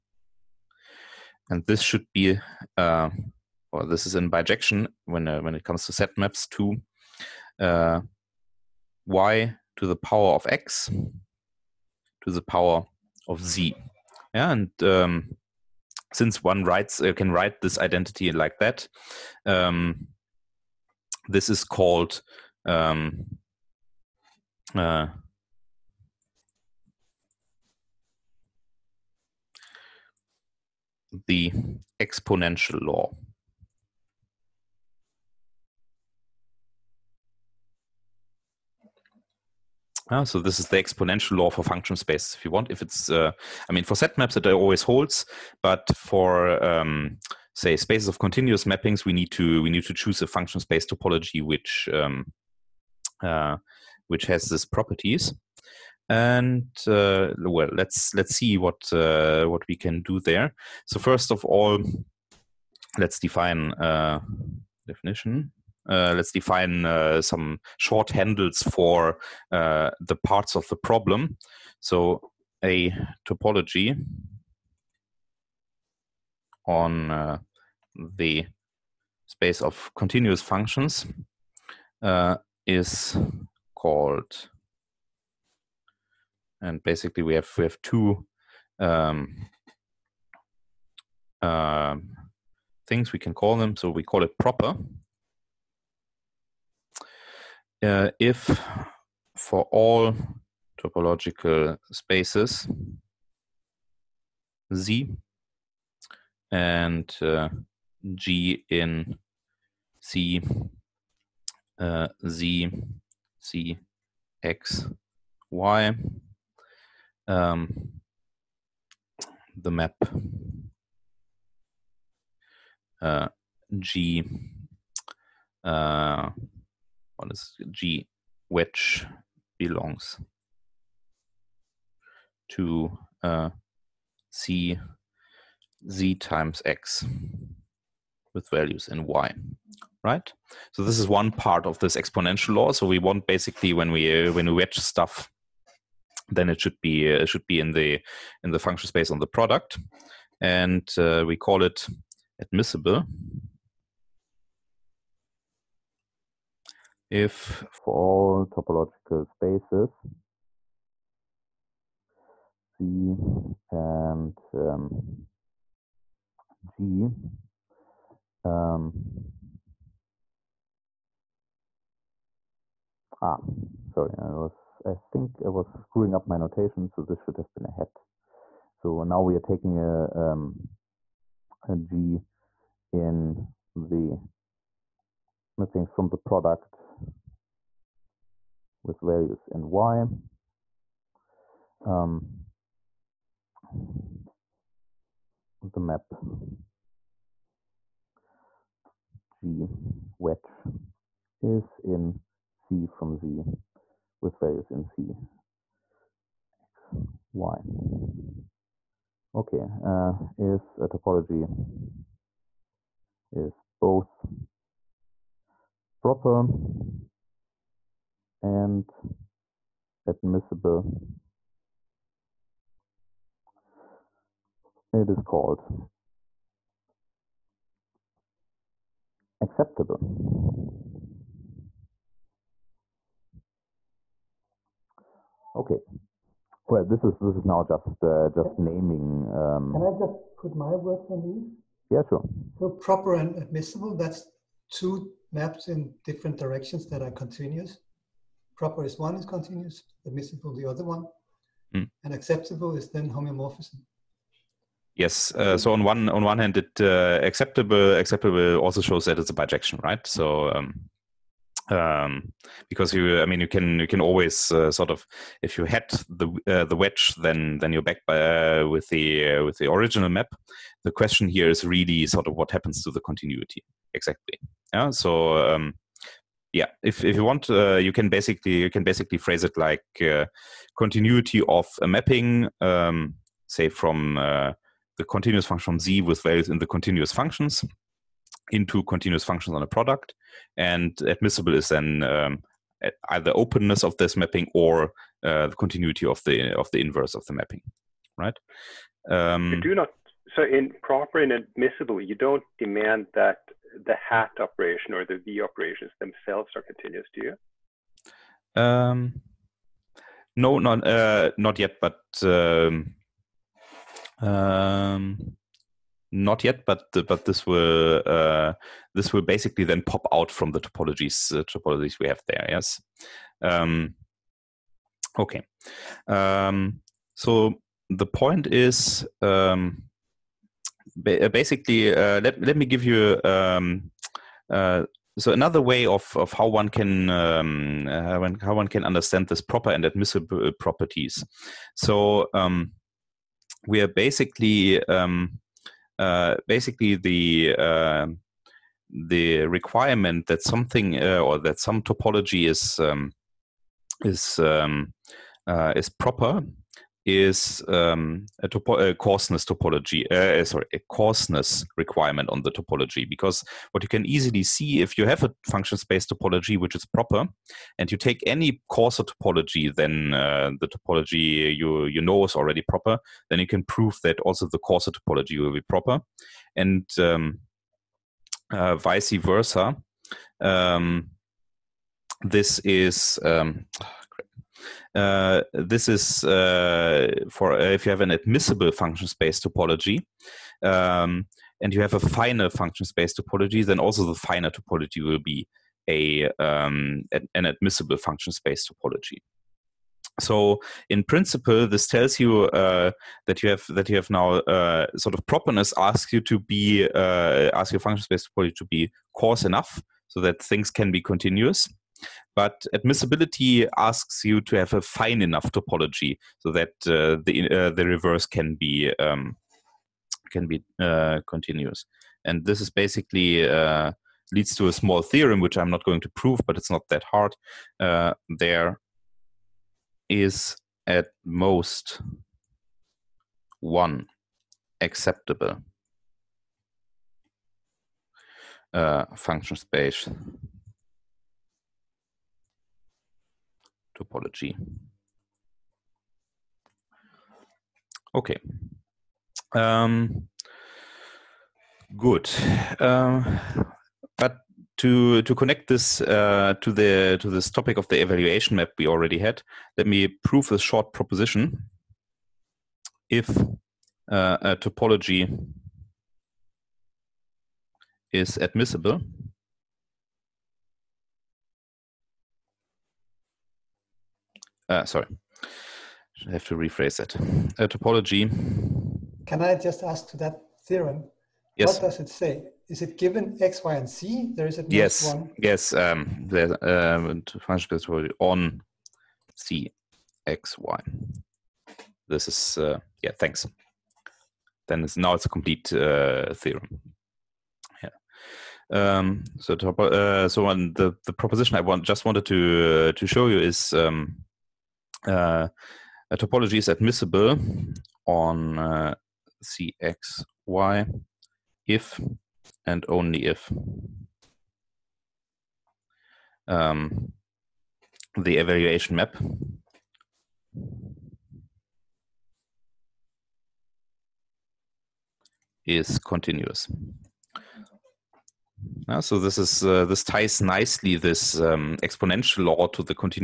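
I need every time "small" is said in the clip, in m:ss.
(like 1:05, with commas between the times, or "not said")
7:04.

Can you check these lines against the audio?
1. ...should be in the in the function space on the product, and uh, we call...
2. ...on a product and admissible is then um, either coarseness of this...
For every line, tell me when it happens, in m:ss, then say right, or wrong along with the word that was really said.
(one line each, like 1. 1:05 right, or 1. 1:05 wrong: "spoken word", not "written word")
1. 2:27 right
2. 4:49 wrong: "openness", not "coarseness".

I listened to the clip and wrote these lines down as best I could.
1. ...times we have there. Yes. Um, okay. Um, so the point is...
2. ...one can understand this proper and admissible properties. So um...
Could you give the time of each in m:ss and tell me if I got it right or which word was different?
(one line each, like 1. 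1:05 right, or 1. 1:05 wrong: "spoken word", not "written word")
1. 5:21 wrong: "topologies", not "times"
2. 5:38 right.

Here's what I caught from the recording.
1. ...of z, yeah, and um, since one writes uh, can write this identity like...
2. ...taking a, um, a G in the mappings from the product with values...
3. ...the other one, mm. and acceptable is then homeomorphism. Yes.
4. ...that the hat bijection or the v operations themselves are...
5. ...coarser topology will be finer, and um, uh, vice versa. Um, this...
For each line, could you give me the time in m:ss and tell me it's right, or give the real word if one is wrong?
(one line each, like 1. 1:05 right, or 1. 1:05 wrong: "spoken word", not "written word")
1. 0:13 right
2. 2:59 right
3. 4:10 right
4. 5:03 wrong: "operation", not "bijection"
5. 6:14 wrong: "proper", not "finer".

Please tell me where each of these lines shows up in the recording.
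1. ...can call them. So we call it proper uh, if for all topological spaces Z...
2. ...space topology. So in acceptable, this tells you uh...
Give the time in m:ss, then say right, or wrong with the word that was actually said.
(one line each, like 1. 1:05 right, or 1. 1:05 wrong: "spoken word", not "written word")
1. 1:33 right
2. 6:38 wrong: "principle", not "acceptable".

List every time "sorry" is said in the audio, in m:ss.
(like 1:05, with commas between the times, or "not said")
2:53, 6:00, 7:54.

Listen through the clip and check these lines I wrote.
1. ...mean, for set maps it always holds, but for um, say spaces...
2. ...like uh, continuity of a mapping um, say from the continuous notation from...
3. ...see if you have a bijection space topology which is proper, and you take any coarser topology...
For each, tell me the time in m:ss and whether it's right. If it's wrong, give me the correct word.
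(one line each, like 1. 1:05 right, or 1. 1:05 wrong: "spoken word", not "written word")
1. 0:43 right
2. 4:39 wrong: "function", not "notation"
3. 6:04 wrong: "function", not "bijection".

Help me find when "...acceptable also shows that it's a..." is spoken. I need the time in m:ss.
4:17.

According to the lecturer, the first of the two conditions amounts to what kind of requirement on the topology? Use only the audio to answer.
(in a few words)
Coarseness requirement.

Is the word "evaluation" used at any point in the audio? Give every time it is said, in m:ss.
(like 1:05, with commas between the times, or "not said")
7:38, 8:38.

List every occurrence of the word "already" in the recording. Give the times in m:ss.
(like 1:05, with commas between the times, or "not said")
6:12, 7:38.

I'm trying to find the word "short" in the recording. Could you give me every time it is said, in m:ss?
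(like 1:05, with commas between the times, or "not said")
1:07, 7:40.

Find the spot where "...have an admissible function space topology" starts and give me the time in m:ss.
6:27.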